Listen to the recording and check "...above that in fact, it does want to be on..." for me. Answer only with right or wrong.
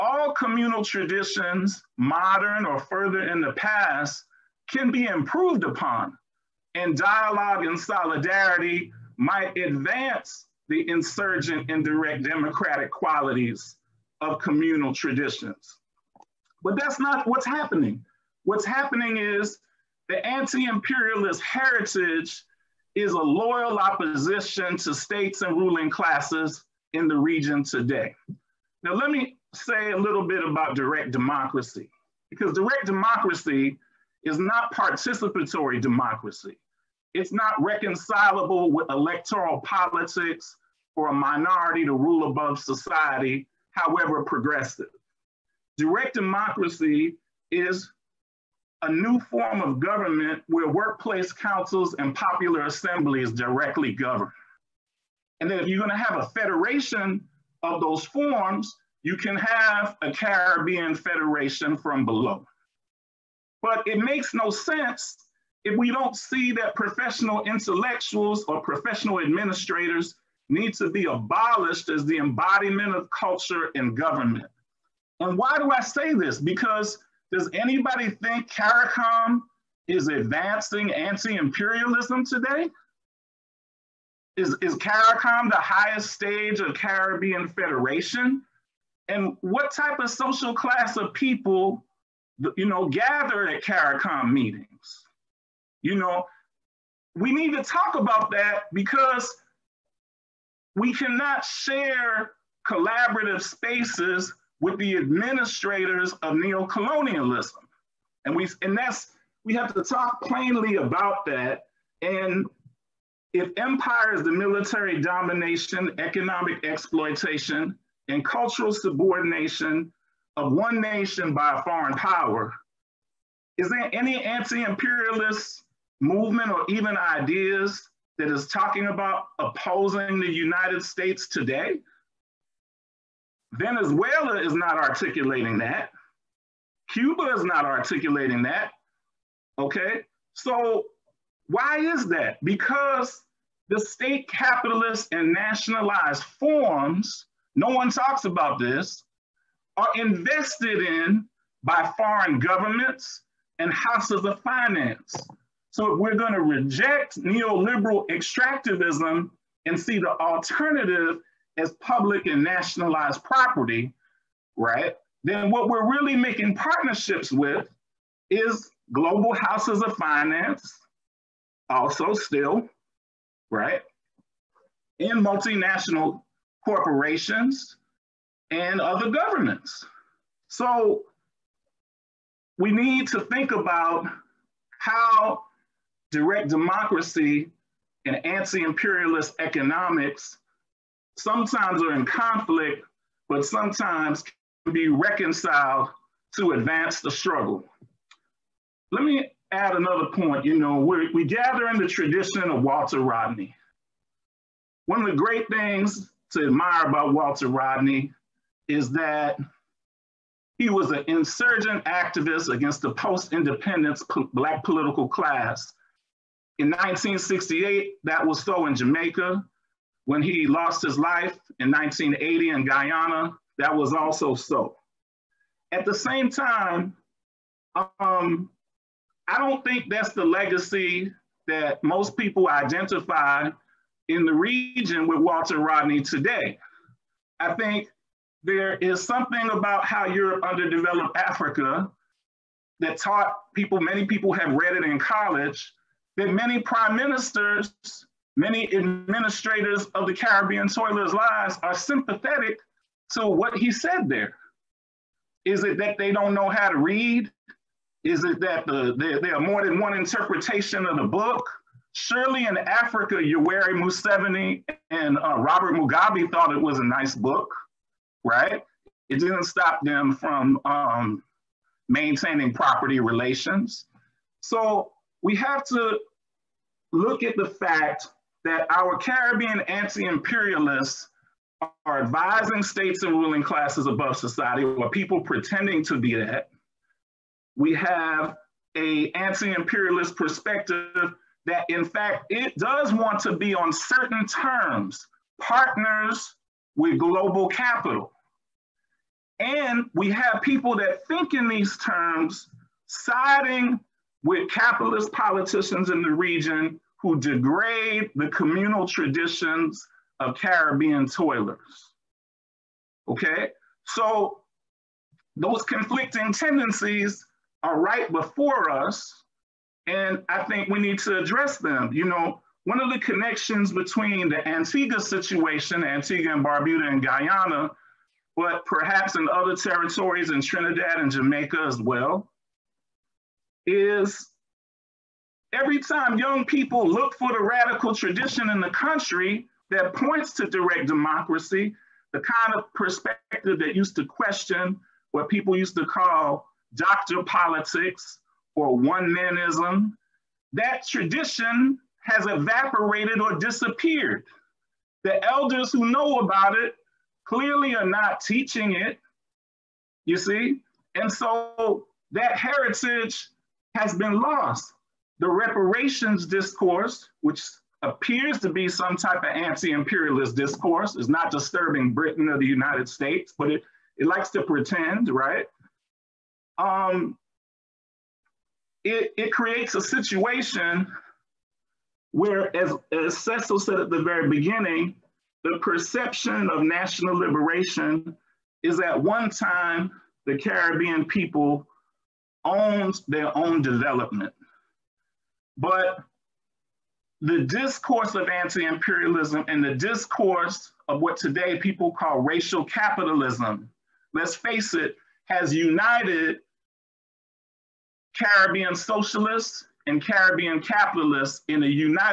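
wrong.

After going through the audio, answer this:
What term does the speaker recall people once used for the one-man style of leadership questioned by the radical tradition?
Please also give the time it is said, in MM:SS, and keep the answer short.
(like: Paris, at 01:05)
Dr. Politics, at 05:46.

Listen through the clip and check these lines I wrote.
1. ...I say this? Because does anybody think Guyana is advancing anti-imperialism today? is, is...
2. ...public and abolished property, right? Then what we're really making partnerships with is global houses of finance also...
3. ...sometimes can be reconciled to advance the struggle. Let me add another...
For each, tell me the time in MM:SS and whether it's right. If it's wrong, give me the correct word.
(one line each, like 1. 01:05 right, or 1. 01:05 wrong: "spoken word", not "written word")
1. 01:15 wrong: "CARICOM", not "Guyana"
2. 02:41 wrong: "nationalized", not "abolished"
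3. 03:13 right.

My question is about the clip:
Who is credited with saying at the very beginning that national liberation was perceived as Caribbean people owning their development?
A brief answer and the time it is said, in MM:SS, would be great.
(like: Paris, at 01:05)
Cecil, at 06:23.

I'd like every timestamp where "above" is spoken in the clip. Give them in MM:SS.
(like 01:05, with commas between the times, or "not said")
00:42, 04:43.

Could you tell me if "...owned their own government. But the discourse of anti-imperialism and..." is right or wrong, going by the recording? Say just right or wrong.
wrong.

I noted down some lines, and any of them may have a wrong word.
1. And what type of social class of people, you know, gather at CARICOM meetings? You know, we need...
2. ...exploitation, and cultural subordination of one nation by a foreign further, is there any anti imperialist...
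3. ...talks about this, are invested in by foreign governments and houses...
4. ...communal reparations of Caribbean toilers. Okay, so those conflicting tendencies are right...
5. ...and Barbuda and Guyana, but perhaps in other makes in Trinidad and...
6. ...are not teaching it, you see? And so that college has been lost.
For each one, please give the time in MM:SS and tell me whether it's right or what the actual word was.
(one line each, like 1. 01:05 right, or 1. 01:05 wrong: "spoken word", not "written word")
1. 01:29 right
2. 01:56 wrong: "power", not "further"
3. 02:27 right
4. 05:08 wrong: "traditions", not "reparations"
5. 05:26 wrong: "territories", not "makes"
6. 05:57 wrong: "heritage", not "college".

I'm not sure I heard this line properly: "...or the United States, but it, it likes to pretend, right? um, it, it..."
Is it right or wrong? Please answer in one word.
right.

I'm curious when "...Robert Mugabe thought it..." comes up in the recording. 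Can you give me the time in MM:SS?
04:25.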